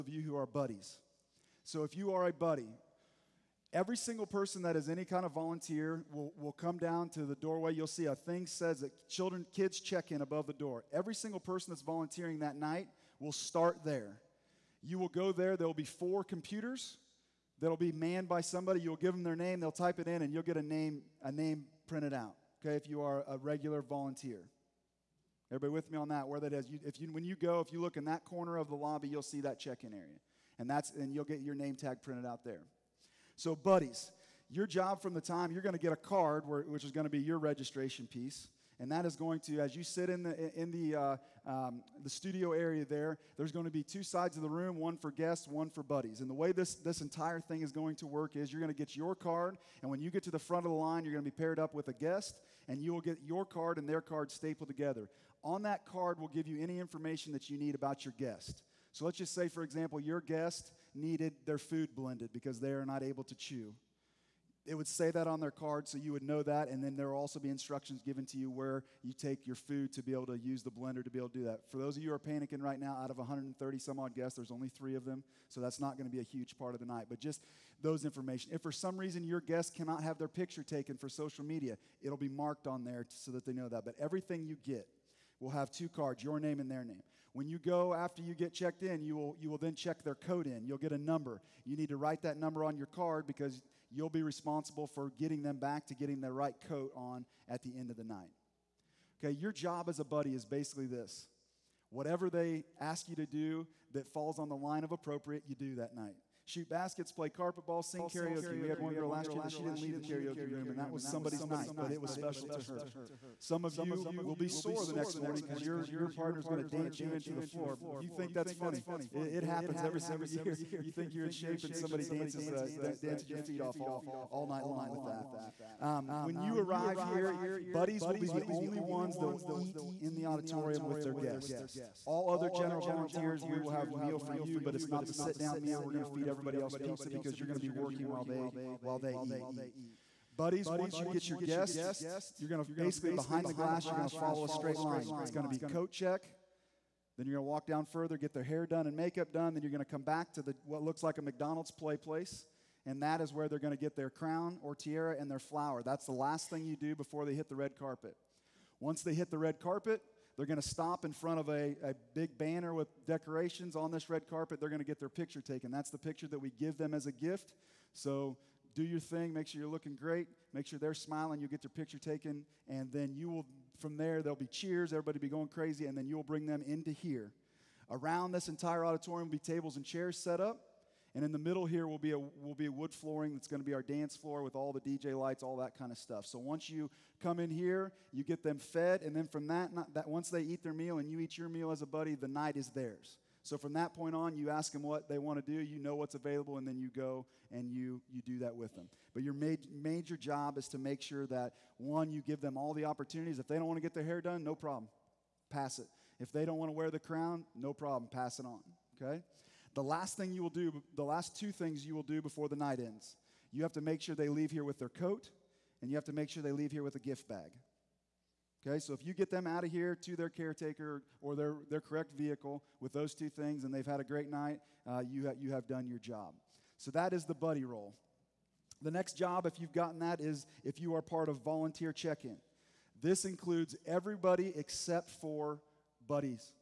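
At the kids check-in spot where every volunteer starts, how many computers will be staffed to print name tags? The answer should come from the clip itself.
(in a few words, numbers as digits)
4.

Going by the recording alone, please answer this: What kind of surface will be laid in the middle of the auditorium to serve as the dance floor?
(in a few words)
wood flooring.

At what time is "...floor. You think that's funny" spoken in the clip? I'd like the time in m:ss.
1:57.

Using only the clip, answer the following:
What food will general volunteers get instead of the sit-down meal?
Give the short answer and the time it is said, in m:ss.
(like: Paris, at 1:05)
pizza, at 2:16.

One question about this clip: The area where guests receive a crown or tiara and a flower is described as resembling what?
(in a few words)
a McDonald's play place.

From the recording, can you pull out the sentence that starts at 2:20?
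Buddies, once you get your guest, you're going to basically behind the glass, you're going to follow a straight line.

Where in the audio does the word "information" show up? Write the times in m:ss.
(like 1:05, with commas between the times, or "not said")
0:56, 1:18.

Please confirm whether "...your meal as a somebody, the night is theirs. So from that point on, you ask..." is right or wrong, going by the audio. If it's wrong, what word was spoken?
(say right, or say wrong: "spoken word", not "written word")
wrong: "buddy", not "somebody".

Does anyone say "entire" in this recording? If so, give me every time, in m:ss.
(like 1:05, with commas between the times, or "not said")
0:47, 2:58.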